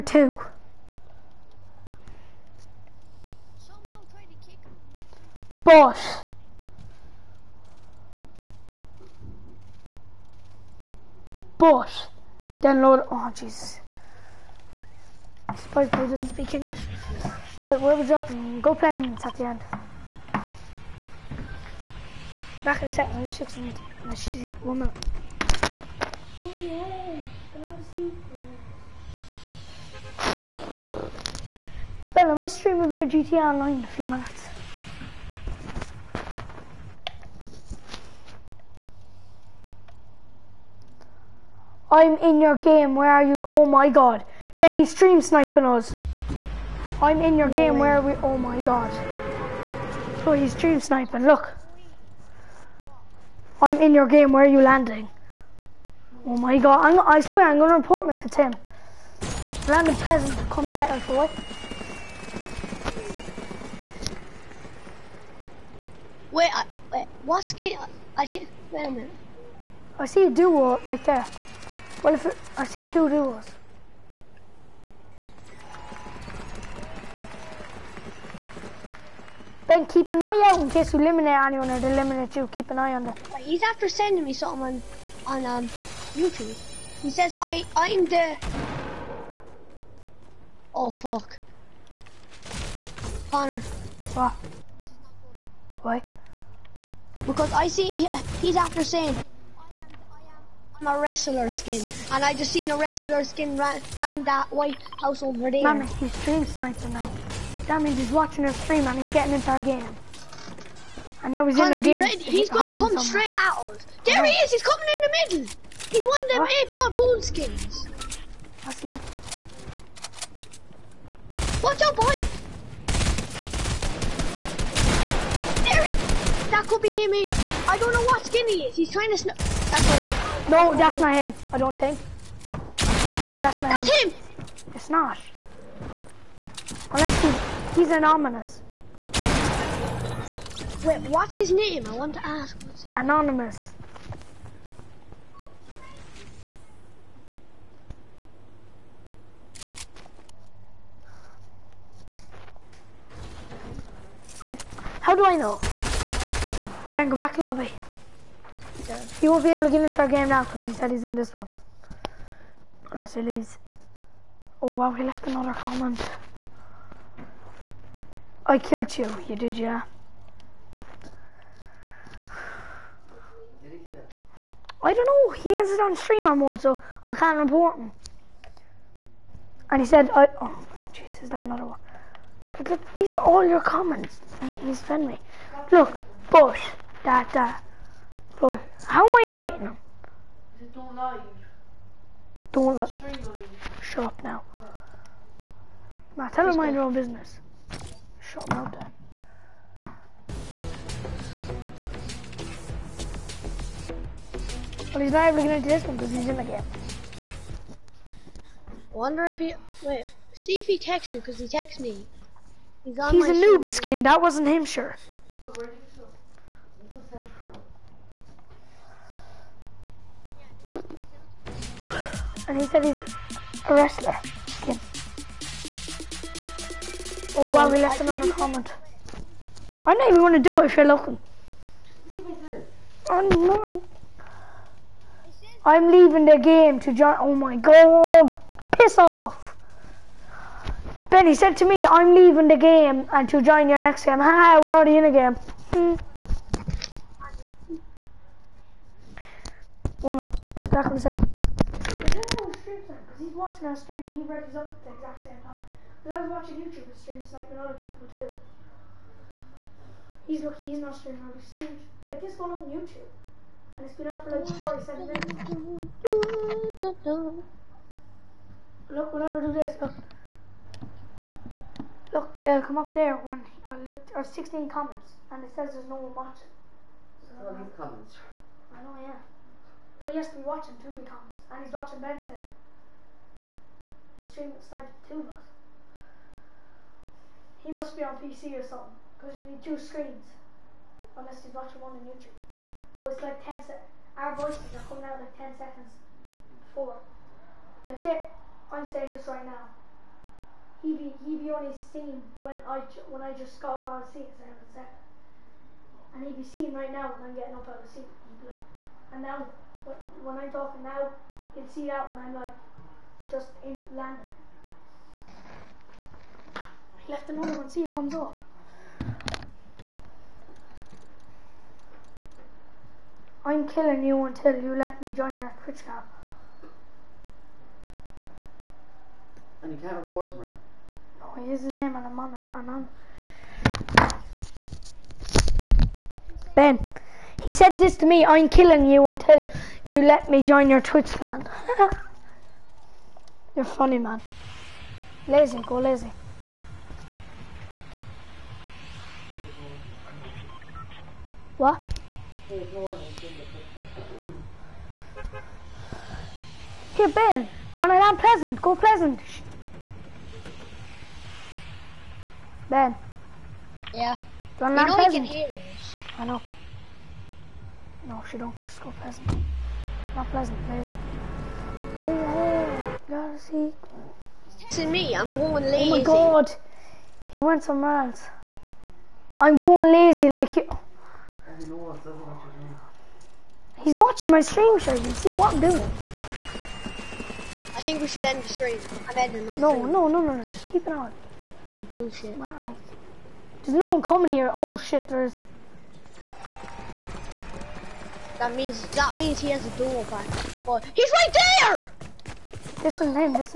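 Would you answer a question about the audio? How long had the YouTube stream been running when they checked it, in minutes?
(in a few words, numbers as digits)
47.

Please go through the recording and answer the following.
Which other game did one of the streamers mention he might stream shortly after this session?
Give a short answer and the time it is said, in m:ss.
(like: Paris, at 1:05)
GTA Online, at 0:33.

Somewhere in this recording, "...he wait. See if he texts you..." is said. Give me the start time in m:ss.
3:29.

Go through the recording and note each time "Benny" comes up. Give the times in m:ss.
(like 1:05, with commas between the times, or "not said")
0:44, 4:01.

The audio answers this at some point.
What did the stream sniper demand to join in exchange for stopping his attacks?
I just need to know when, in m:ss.
5:40.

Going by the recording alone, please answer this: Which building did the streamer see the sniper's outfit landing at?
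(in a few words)
White House.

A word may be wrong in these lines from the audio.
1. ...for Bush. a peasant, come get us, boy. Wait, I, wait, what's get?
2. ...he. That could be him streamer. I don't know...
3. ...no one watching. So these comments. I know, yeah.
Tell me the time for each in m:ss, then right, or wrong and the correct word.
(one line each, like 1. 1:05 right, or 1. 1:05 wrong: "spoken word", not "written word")
1. 0:58 wrong: "Tim", not "Bush"
2. 2:05 wrong: "either", not "streamer"
3. 4:35 right.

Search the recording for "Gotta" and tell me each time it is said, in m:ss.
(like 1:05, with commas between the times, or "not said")
6:13.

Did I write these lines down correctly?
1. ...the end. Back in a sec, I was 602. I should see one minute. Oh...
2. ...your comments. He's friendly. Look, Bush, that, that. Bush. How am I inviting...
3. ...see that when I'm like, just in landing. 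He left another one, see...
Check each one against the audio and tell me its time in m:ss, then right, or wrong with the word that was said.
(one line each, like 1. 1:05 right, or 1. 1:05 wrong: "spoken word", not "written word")
1. 0:19 wrong: "600", not "602"
2. 3:03 right
3. 5:11 right.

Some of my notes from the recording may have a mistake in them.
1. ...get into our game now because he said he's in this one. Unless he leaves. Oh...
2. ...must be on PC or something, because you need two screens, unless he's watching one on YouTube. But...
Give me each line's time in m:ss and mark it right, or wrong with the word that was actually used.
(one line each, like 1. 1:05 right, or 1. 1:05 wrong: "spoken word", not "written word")
1. 2:39 right
2. 4:47 right.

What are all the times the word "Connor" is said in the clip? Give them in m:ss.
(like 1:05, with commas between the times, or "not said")
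1:33, 1:51.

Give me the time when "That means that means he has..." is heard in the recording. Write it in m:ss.
6:38.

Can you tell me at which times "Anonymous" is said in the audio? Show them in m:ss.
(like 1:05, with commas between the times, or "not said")
2:22.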